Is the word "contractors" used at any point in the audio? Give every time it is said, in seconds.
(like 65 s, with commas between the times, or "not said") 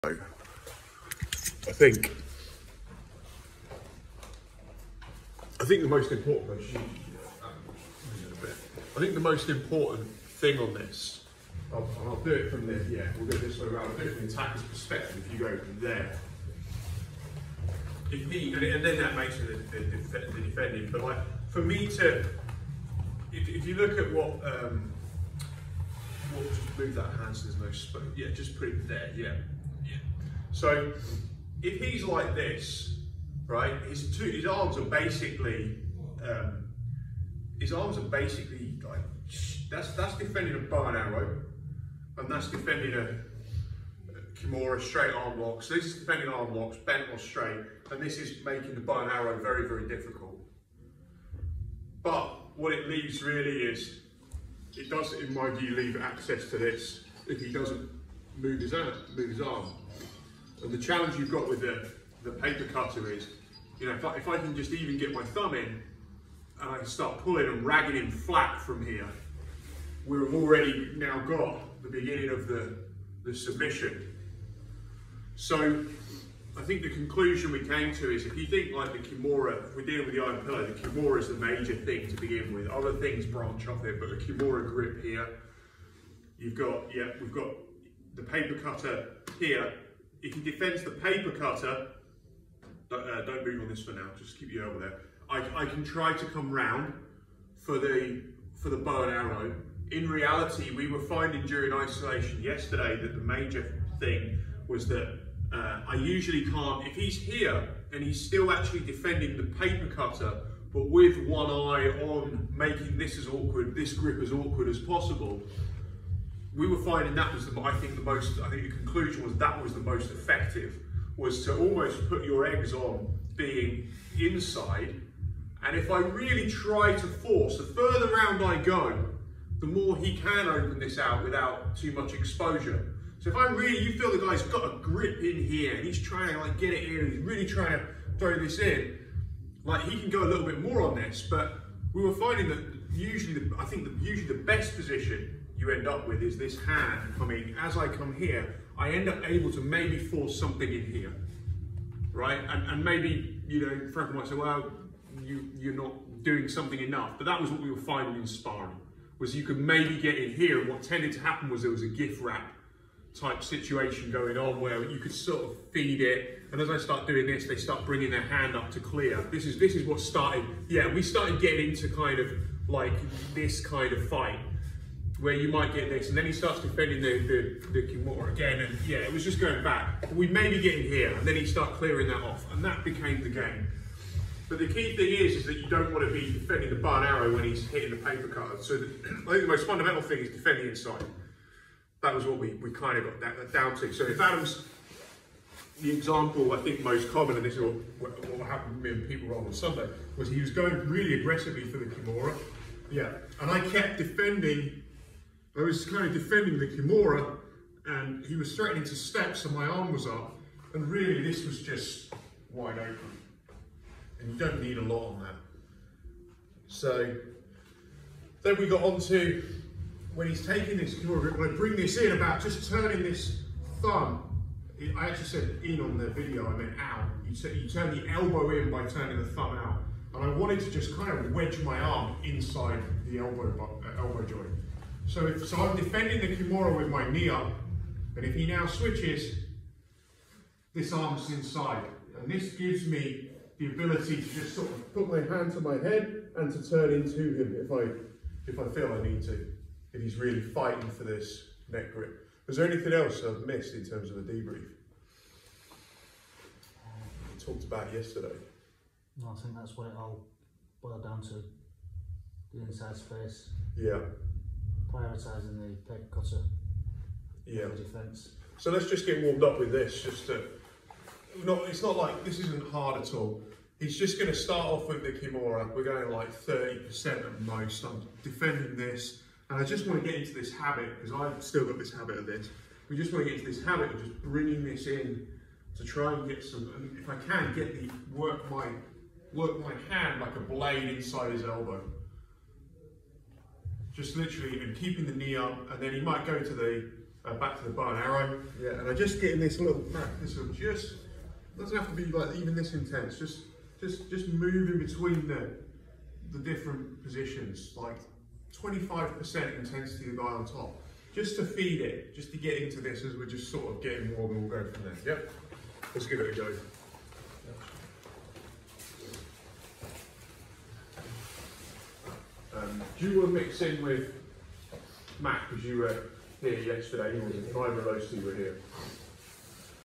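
not said.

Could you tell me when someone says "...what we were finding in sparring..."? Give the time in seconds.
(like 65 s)
157 s.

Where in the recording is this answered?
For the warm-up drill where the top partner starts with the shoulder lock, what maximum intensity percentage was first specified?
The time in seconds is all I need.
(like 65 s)
276 s.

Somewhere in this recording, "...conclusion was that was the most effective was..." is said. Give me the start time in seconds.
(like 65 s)
118 s.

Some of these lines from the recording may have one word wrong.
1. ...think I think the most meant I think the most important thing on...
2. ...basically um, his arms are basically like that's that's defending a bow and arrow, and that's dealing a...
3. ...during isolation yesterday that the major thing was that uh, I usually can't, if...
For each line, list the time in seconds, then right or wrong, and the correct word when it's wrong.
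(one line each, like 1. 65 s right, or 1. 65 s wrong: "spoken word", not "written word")
1. 1 s wrong: "important", not "meant"
2. 34 s wrong: "defending", not "dealing"
3. 101 s right.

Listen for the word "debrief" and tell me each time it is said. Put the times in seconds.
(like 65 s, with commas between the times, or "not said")
254 s.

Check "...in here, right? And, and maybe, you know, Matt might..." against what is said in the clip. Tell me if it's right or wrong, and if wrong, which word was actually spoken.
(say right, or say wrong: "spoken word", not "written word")
wrong: "Frank", not "Matt".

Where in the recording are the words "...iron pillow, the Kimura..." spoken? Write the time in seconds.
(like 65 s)
80 s.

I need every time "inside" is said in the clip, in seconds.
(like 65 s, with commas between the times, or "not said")
124 s, 190 s, 232 s, 241 s, 262 s, 290 s.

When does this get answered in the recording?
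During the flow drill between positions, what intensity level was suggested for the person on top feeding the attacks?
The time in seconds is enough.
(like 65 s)
308 s.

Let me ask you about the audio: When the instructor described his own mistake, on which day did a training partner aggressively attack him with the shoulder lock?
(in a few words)
Sunday.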